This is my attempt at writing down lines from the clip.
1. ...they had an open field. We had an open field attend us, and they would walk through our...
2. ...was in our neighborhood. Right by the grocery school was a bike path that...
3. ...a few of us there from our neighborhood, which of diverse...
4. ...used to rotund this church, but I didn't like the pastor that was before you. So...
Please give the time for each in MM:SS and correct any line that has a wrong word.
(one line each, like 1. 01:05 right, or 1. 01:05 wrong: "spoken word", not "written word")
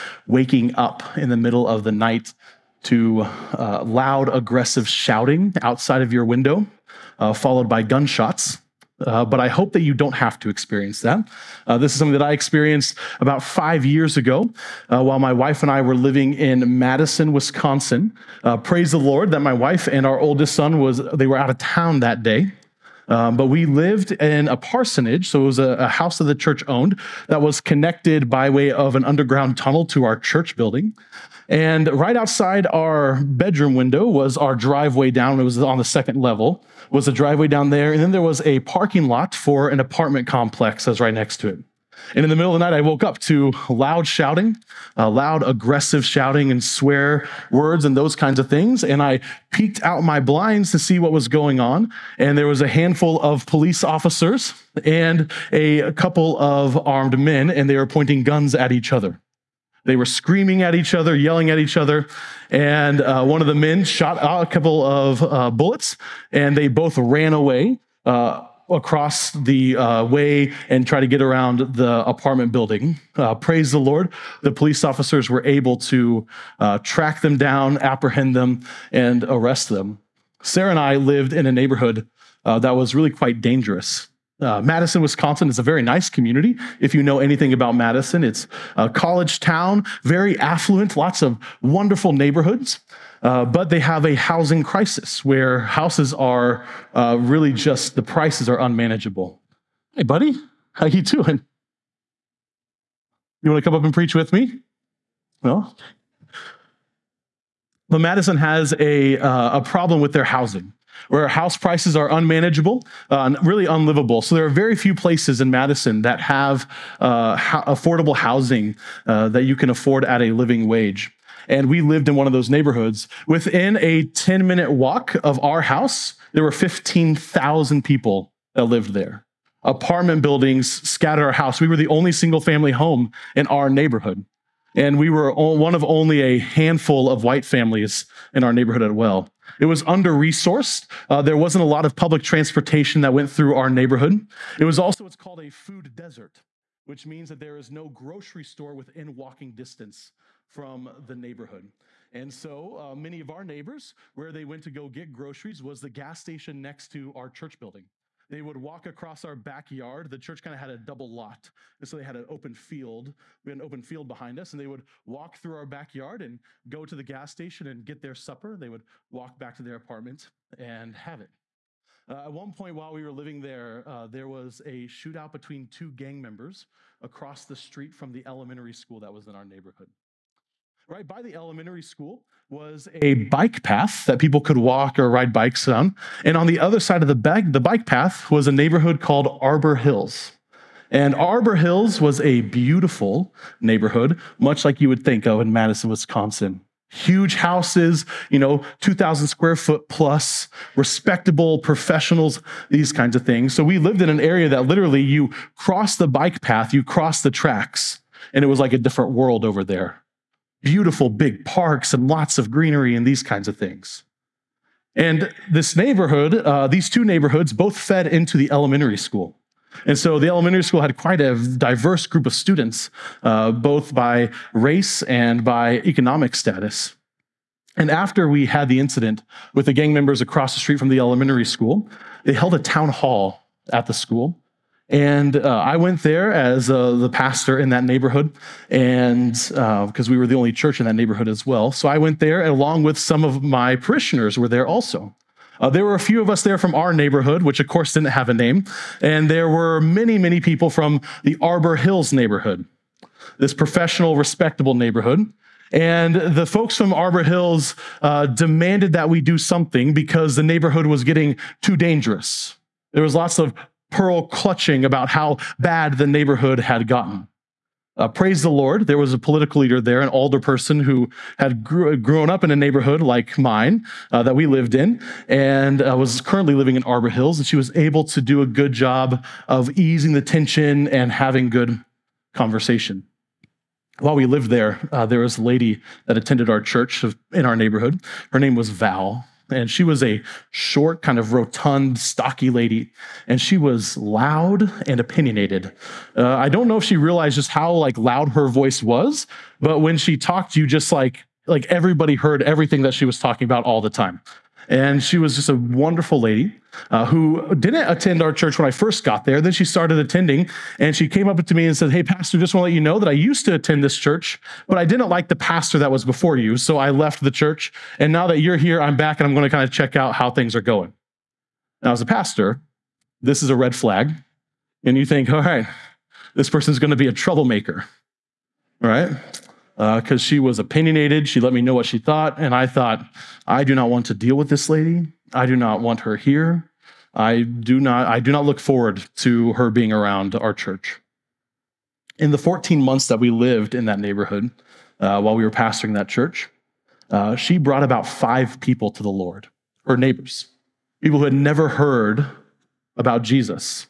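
1. 02:41 wrong: "behind", not "attend"
2. 02:59 wrong: "elementary", not "grocery"
3. 04:05 wrong: "course", not "diverse"
4. 05:13 wrong: "attend", not "rotund".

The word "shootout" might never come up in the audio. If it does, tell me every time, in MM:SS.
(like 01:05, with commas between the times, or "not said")
02:54.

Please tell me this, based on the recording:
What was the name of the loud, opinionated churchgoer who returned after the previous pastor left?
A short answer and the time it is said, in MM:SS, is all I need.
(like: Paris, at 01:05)
Val, at 04:48.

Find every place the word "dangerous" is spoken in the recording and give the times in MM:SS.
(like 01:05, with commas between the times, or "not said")
01:23, 04:21.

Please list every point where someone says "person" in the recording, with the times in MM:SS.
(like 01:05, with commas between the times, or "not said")
04:30, 05:26.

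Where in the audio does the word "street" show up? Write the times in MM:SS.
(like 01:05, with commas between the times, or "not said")
02:57, 03:50.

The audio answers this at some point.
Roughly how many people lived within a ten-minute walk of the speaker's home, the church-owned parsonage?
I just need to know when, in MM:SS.
02:06.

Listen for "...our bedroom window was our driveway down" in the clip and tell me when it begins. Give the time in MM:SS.
00:32.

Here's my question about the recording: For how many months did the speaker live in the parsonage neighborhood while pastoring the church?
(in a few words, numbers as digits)
14.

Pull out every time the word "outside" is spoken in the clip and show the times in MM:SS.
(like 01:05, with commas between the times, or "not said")
00:05, 00:32.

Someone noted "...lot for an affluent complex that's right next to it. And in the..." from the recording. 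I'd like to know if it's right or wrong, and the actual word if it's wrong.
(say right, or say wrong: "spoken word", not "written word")
wrong: "apartment", not "affluent".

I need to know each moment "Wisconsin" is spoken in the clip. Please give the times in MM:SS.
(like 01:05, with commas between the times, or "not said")
00:17, 01:25, 03:15.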